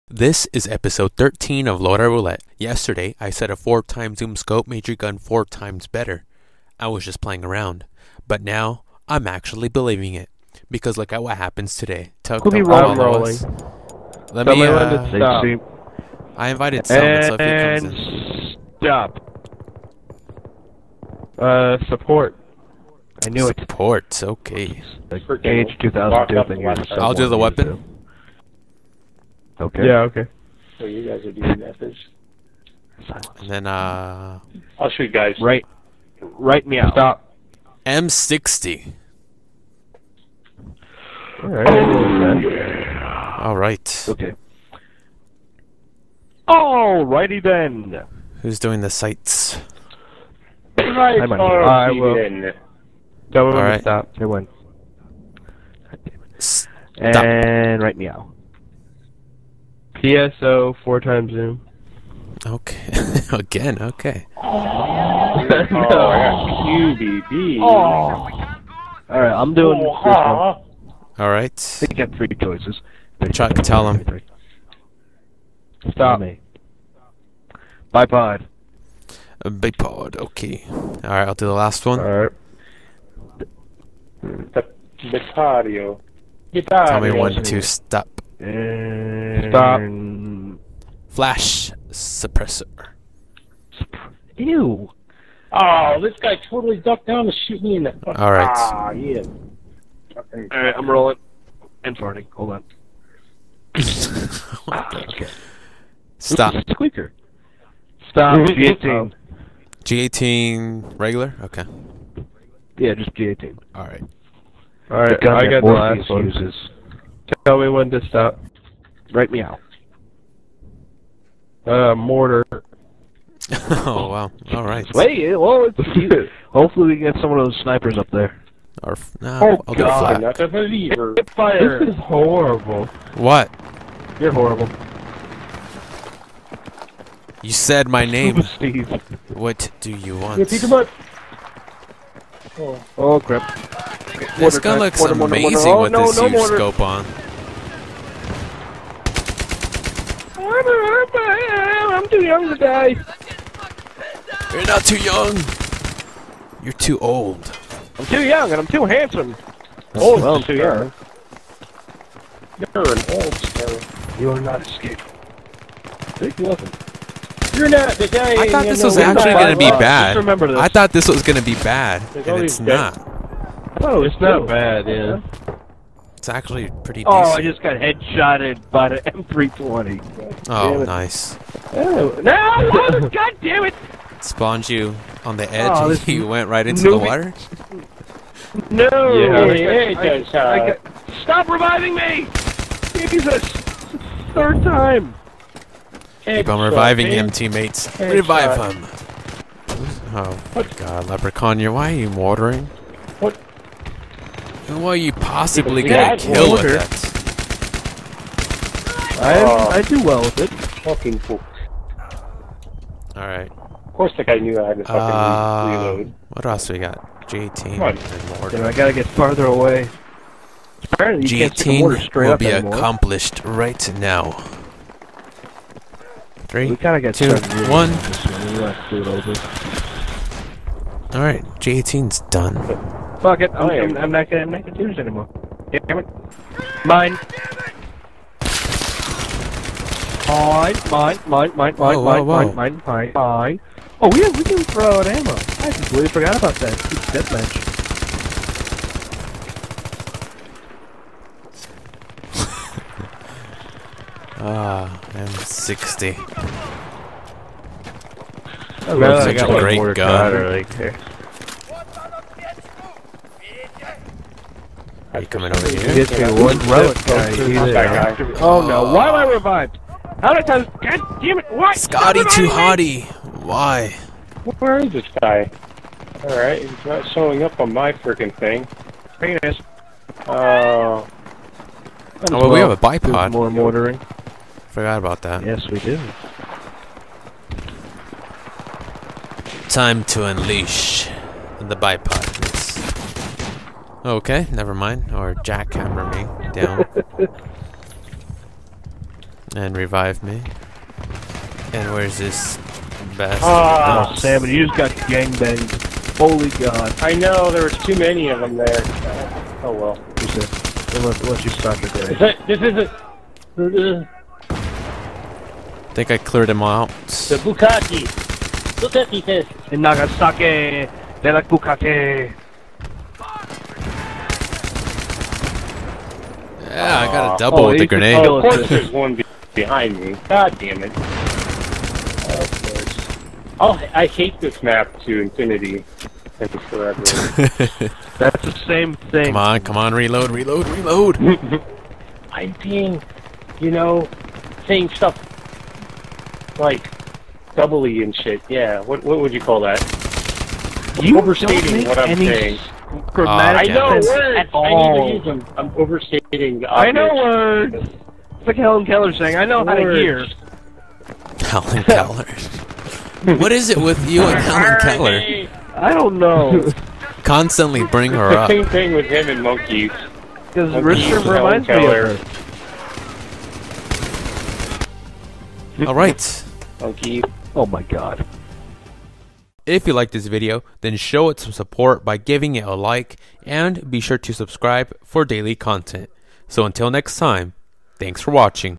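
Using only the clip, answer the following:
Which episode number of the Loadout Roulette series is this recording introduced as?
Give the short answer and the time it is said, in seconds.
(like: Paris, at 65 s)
13, at 0 s.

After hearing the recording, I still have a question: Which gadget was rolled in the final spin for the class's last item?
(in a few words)
Mortar.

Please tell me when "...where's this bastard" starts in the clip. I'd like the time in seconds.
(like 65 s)
301 s.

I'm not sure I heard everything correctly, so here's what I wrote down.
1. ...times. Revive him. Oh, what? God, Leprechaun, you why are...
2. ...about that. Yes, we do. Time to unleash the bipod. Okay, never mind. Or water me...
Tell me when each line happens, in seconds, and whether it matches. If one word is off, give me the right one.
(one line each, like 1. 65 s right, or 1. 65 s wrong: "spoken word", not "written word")
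1. 197 s wrong: "teammates", not "times"
2. 284 s wrong: "jackhammer", not "water".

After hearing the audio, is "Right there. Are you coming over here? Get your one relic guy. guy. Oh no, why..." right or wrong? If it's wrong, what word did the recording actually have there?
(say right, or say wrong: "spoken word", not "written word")
right.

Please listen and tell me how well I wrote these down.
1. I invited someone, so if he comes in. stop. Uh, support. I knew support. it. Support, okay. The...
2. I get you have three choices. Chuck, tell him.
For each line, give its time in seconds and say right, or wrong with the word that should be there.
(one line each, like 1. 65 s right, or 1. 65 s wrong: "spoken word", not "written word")
1. 16 s right
2. 71 s right.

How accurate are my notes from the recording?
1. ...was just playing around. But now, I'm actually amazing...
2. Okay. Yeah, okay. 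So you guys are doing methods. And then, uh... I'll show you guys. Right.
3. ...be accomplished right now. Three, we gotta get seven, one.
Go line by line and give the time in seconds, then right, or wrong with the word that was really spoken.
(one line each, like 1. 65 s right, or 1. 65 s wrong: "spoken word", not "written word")
1. 6 s wrong: "believing", not "amazing"
2. 29 s right
3. 222 s wrong: "two", not "seven".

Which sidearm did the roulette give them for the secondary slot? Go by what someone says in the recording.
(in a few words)
G18.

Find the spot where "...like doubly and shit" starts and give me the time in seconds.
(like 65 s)
346 s.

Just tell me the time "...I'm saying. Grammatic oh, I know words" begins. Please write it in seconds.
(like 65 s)
351 s.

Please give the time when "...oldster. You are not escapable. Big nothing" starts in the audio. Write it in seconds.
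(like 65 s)
163 s.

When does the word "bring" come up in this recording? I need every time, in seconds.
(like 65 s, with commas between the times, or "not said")
367 s.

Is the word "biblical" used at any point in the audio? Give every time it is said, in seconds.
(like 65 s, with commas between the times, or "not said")
not said.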